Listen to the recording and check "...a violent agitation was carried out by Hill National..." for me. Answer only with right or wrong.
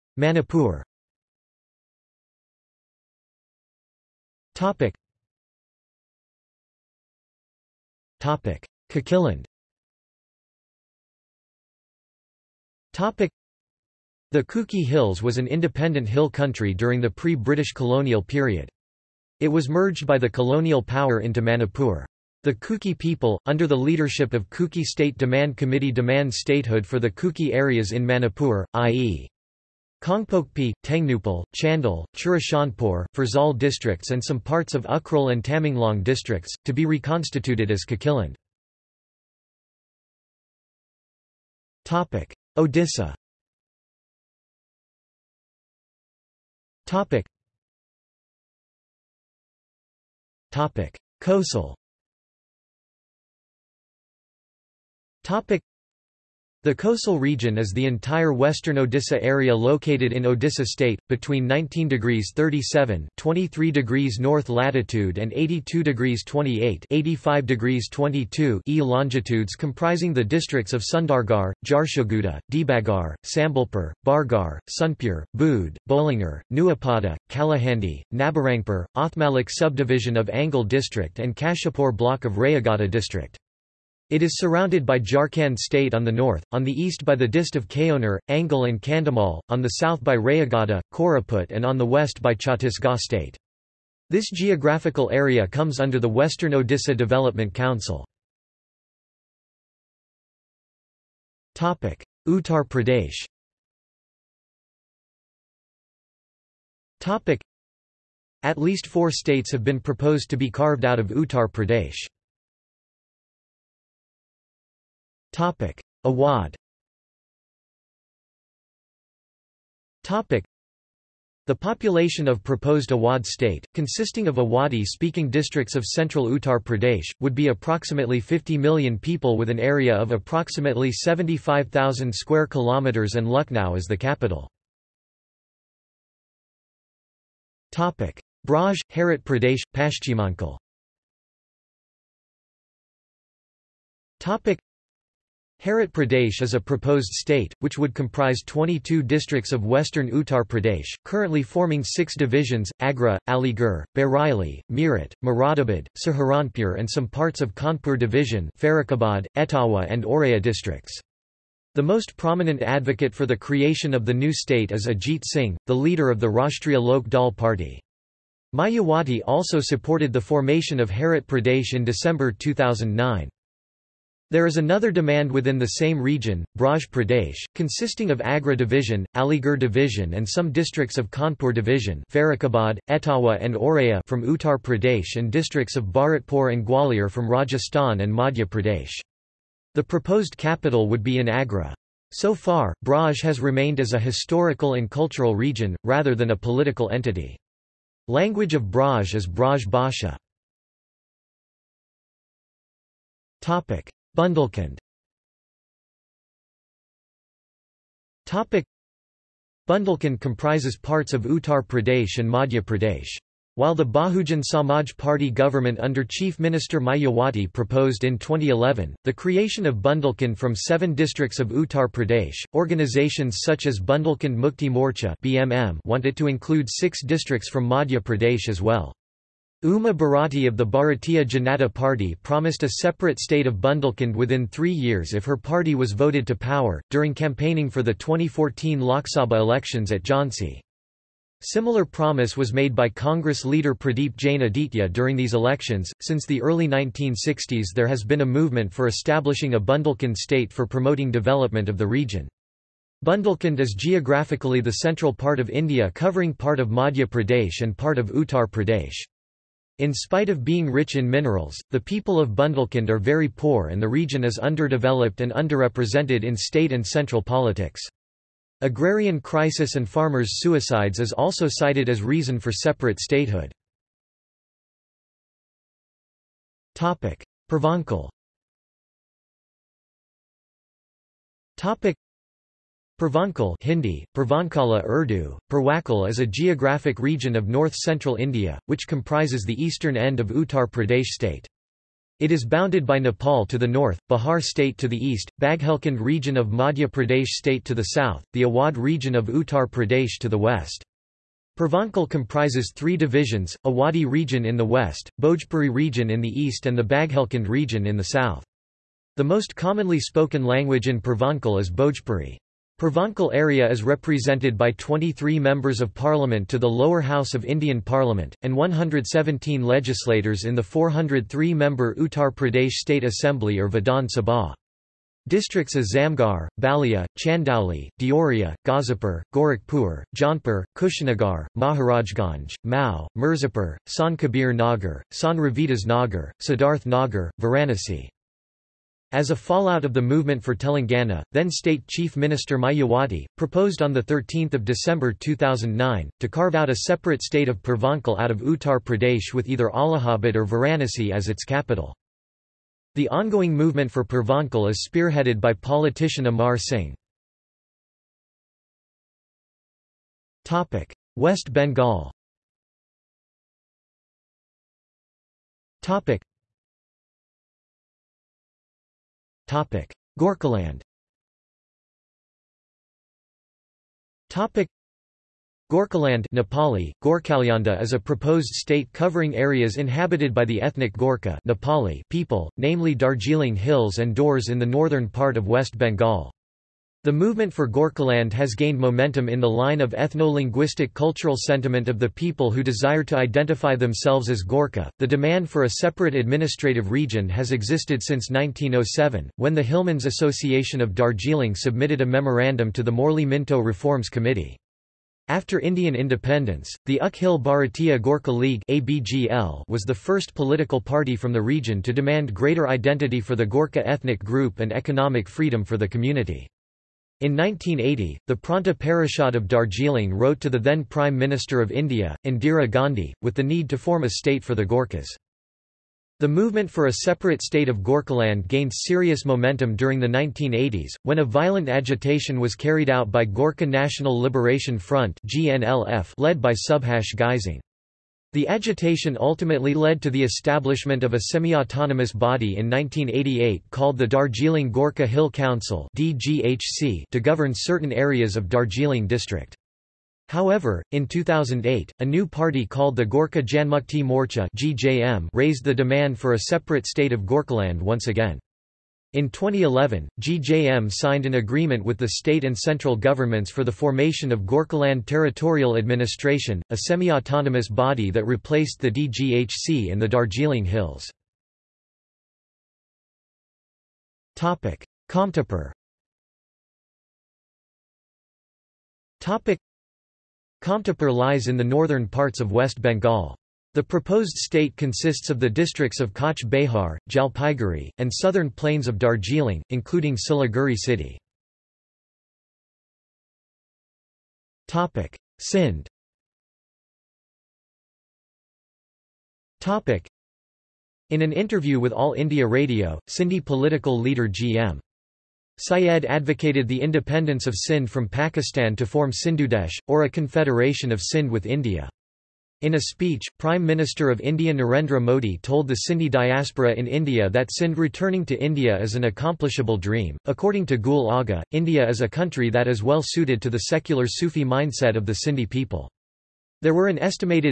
wrong.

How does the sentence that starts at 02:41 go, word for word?
The most prominent advocate for the creation of the new state is Ajit Singh, the leader of the Rashtriya Lok Dal Party.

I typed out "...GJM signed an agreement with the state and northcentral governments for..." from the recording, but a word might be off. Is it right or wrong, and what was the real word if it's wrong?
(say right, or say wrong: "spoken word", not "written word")
wrong: "central", not "northcentral".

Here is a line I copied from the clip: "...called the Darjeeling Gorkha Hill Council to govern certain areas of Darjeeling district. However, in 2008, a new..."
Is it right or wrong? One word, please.
right.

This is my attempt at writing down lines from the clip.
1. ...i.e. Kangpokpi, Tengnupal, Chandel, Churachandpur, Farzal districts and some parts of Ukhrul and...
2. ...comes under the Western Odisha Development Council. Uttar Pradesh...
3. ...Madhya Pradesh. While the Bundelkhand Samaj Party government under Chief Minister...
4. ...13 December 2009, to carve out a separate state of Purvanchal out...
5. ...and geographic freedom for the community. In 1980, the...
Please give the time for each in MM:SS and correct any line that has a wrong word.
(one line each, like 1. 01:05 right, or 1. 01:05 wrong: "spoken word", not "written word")
1. 00:28 right
2. 01:35 right
3. 03:32 wrong: "Bahujan", not "Bundelkhand"
4. 05:43 right
5. 06:54 wrong: "economic", not "geographic".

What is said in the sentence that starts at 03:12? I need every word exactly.
So far, Braj has remained as a historical and cultural region, rather than a political entity.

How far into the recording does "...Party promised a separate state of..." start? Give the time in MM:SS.
03:51.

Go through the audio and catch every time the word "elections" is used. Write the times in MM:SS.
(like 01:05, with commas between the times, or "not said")
03:59, 04:05.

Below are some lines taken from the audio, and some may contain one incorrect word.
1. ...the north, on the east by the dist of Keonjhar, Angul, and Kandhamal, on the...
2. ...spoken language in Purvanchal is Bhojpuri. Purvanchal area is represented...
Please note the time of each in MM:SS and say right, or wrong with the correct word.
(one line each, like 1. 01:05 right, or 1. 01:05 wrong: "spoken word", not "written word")
1. 01:26 right
2. 05:10 right.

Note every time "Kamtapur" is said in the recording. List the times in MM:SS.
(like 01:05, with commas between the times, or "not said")
07:54, 08:00.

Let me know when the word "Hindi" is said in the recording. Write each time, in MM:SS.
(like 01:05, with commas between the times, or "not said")
04:43.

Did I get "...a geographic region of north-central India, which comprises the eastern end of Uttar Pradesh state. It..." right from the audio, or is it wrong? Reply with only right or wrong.
right.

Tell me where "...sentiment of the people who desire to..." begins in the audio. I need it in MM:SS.
06:31.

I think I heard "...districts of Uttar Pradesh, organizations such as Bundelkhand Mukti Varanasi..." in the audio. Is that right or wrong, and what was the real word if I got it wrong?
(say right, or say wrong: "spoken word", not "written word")
wrong: "Morcha", not "Varanasi".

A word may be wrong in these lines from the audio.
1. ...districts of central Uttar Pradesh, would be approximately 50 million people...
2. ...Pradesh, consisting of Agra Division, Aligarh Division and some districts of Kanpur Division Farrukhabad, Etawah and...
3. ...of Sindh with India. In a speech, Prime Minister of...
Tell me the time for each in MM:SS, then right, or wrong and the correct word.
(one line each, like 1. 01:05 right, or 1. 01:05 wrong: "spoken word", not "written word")
1. 02:05 right
2. 02:56 right
3. 08:30 right.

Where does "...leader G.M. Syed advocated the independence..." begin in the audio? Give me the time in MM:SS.
08:23.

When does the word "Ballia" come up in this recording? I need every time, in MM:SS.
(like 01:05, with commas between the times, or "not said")
05:26.